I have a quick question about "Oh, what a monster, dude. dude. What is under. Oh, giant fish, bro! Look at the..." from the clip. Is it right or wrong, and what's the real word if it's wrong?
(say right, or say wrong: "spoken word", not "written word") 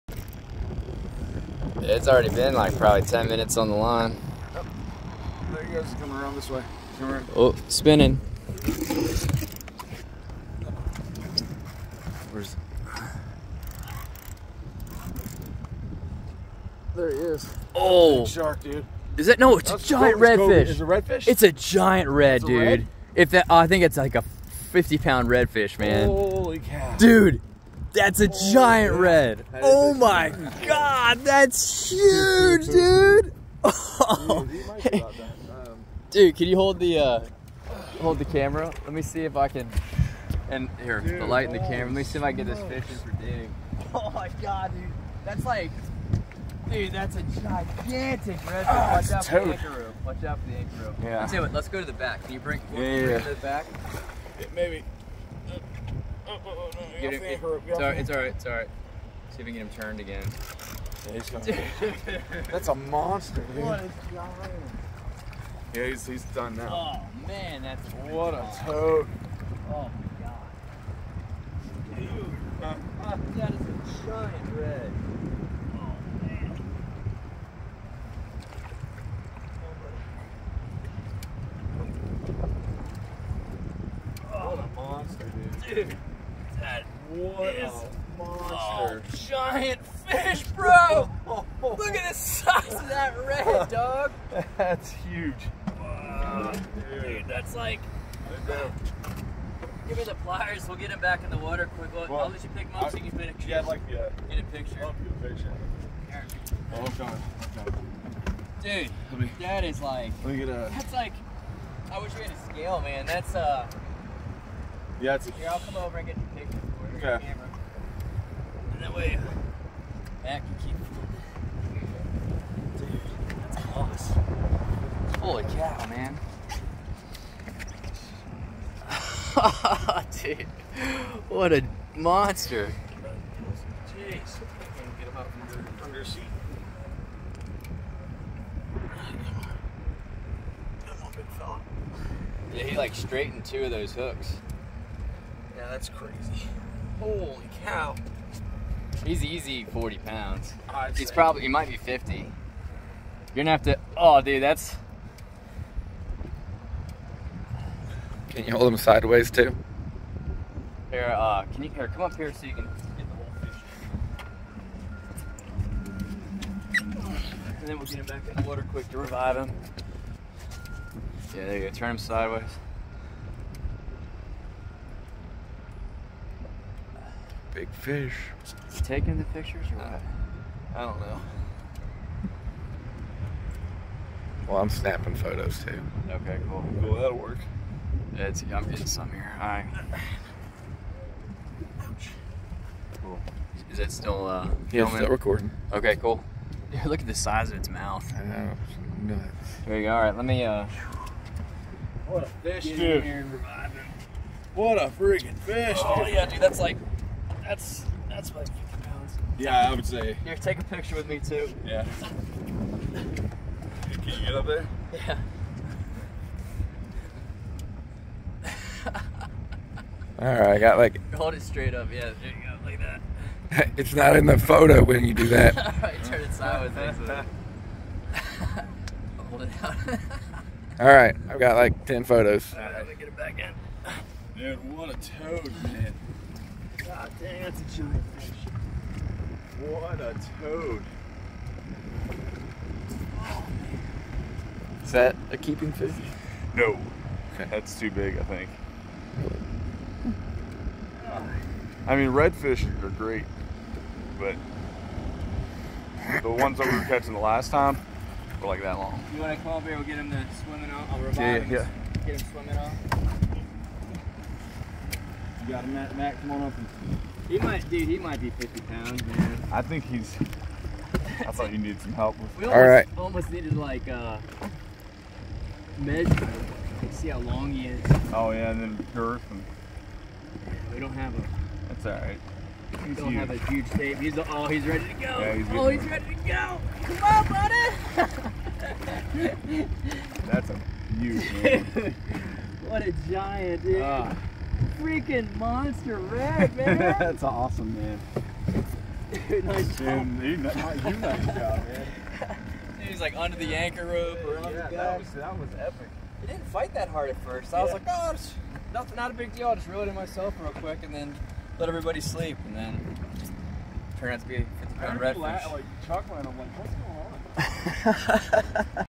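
wrong: "monster", not "under".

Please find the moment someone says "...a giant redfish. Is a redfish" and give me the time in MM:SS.
00:19.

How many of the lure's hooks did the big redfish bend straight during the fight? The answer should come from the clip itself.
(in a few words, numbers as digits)
2.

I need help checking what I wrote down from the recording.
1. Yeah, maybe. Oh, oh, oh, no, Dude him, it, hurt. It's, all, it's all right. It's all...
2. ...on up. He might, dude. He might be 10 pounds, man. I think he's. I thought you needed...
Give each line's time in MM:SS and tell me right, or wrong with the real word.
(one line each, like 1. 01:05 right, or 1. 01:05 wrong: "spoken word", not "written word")
1. 00:54 wrong: "Get", not "Dude"
2. 04:26 wrong: "50", not "10".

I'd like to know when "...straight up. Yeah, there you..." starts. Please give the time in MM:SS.
03:41.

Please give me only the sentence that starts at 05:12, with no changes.
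And then turned out to be a 50 pound redfish.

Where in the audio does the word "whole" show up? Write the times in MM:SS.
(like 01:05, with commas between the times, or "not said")
02:46.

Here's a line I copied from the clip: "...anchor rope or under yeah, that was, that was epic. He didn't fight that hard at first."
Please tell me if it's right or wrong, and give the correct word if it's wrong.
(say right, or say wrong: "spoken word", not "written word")
right.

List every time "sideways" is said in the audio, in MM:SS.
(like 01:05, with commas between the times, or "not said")
02:38, 02:51, 03:46.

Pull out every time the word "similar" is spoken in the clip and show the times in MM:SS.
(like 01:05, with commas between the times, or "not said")
not said.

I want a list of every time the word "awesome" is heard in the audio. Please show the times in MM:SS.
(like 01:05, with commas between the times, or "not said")
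02:03, 04:57.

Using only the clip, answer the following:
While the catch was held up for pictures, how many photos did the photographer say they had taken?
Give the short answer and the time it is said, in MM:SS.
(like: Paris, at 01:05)
10, at 03:51.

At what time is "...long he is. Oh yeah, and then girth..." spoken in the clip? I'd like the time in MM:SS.
04:37.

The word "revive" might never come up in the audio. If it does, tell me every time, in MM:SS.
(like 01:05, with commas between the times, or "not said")
02:48, 04:20.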